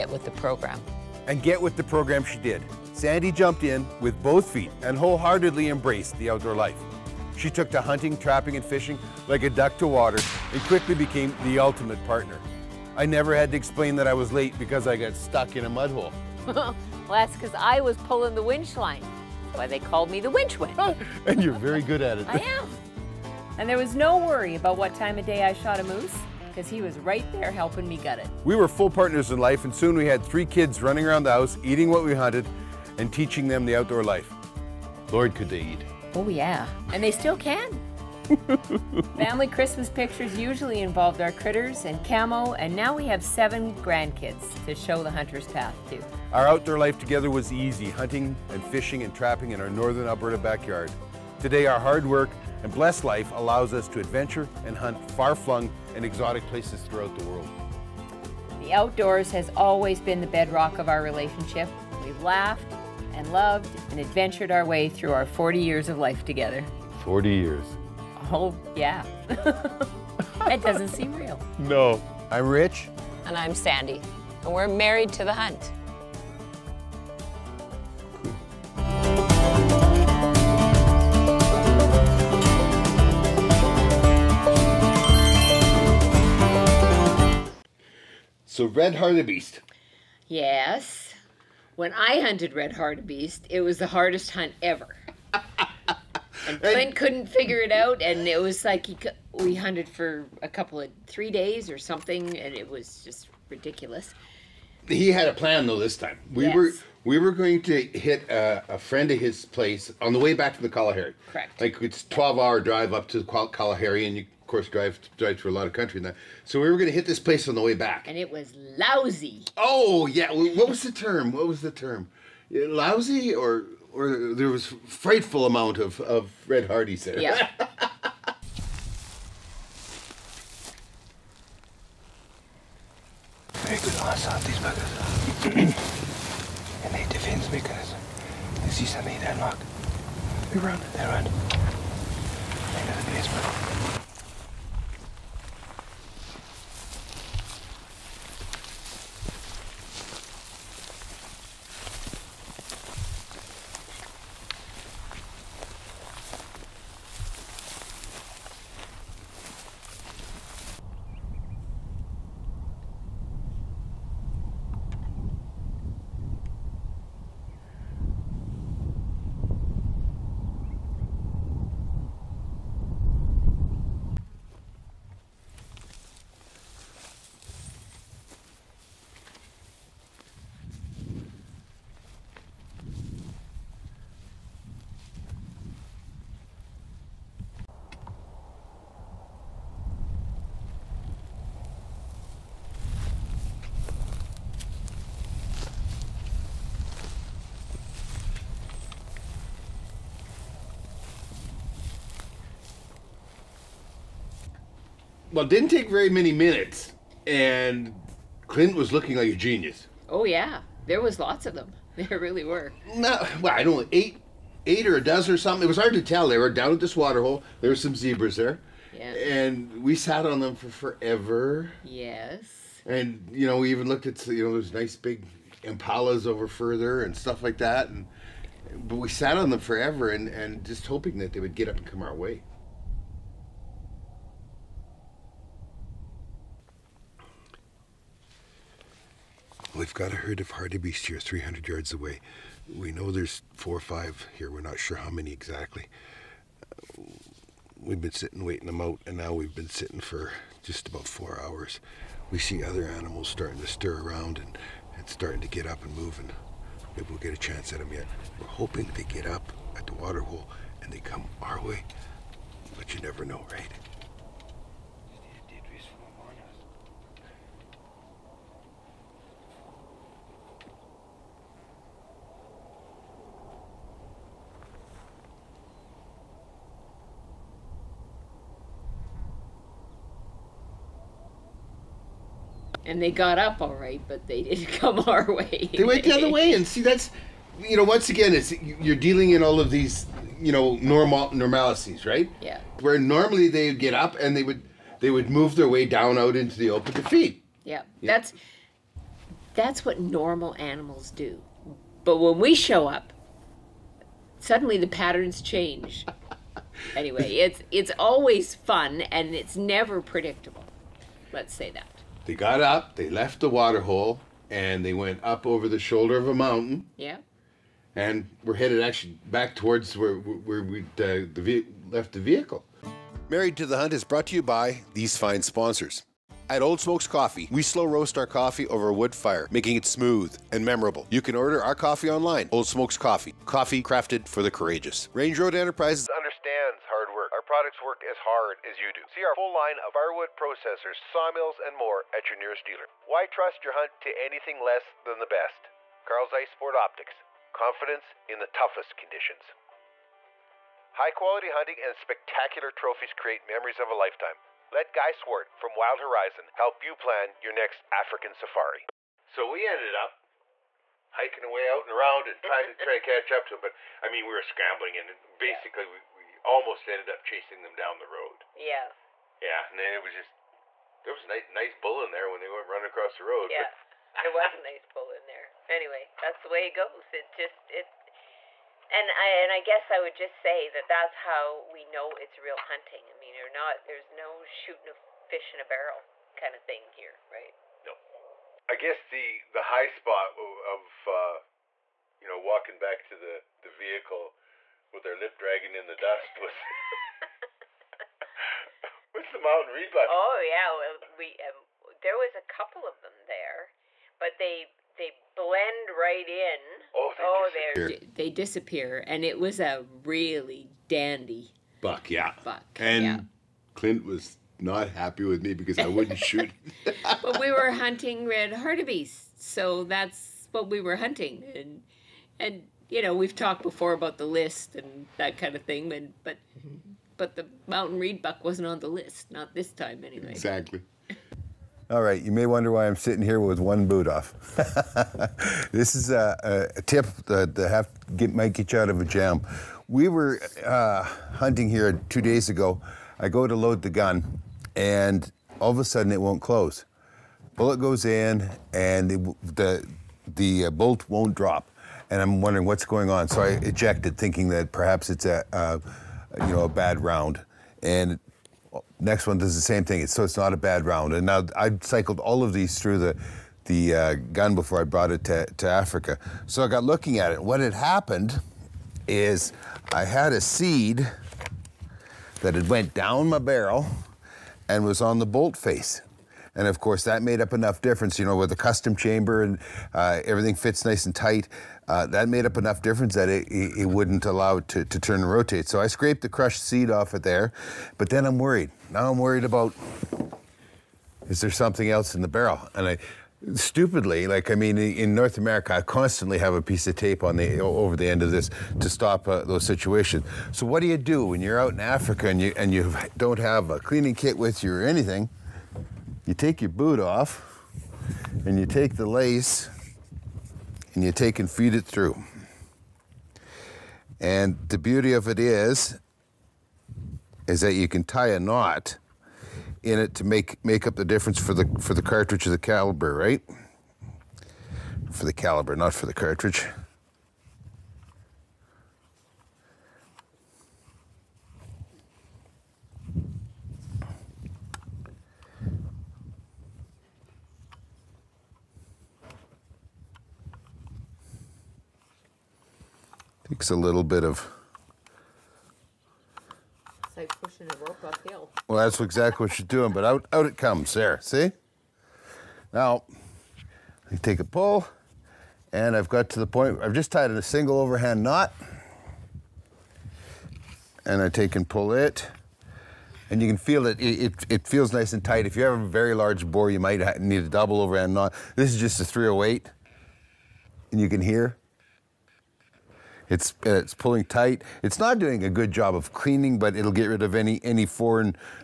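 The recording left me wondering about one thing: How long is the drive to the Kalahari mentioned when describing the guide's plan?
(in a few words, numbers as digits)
12 hours.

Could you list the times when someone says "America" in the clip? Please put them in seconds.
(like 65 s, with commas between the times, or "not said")
495 s.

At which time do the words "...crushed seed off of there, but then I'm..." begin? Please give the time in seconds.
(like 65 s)
486 s.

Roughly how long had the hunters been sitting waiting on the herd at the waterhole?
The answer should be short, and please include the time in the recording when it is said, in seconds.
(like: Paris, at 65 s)
4 hours, at 251 s.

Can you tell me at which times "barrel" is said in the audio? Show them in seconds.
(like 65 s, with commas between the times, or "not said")
385 s, 473 s, 492 s.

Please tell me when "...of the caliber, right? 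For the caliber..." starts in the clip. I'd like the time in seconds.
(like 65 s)
522 s.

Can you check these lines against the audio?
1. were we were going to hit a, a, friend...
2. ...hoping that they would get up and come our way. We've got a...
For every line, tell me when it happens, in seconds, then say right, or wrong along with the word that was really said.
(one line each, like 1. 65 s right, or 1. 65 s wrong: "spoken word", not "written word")
1. 106 s right
2. 230 s right.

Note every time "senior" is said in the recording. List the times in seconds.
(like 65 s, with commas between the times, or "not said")
not said.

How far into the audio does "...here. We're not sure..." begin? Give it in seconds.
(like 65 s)
244 s.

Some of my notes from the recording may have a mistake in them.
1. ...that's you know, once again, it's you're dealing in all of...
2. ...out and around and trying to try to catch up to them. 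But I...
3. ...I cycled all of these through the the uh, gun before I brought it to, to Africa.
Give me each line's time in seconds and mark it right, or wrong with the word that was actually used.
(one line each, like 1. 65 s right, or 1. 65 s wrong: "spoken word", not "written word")
1. 286 s right
2. 361 s right
3. 461 s right.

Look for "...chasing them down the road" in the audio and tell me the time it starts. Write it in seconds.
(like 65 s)
367 s.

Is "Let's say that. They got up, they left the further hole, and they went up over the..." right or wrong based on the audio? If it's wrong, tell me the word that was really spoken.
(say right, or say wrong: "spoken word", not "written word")
wrong: "water", not "further".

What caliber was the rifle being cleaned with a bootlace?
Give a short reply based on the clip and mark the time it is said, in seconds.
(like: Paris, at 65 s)
308, at 569 s.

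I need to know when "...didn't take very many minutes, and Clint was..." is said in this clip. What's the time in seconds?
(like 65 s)
205 s.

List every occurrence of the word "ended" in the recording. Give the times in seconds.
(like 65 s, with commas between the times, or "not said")
359 s, 366 s.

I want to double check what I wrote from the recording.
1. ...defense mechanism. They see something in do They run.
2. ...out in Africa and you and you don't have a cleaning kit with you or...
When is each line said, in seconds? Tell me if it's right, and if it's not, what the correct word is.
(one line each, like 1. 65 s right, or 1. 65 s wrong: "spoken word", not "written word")
1. 137 s right
2. 501 s right.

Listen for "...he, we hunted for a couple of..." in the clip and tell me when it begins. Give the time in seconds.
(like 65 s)
98 s.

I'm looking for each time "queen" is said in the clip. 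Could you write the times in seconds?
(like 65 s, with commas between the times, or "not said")
not said.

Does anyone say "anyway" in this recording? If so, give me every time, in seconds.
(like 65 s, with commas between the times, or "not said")
306 s, 375 s, 430 s.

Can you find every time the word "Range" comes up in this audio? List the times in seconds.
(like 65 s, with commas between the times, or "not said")
335 s.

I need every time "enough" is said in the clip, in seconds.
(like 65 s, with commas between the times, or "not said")
477 s, 482 s.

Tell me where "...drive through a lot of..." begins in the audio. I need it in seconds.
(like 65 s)
115 s.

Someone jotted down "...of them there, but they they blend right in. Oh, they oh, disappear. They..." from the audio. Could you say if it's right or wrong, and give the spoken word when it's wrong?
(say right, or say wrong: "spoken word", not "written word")
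right.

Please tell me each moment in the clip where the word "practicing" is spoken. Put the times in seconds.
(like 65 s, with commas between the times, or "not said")
not said.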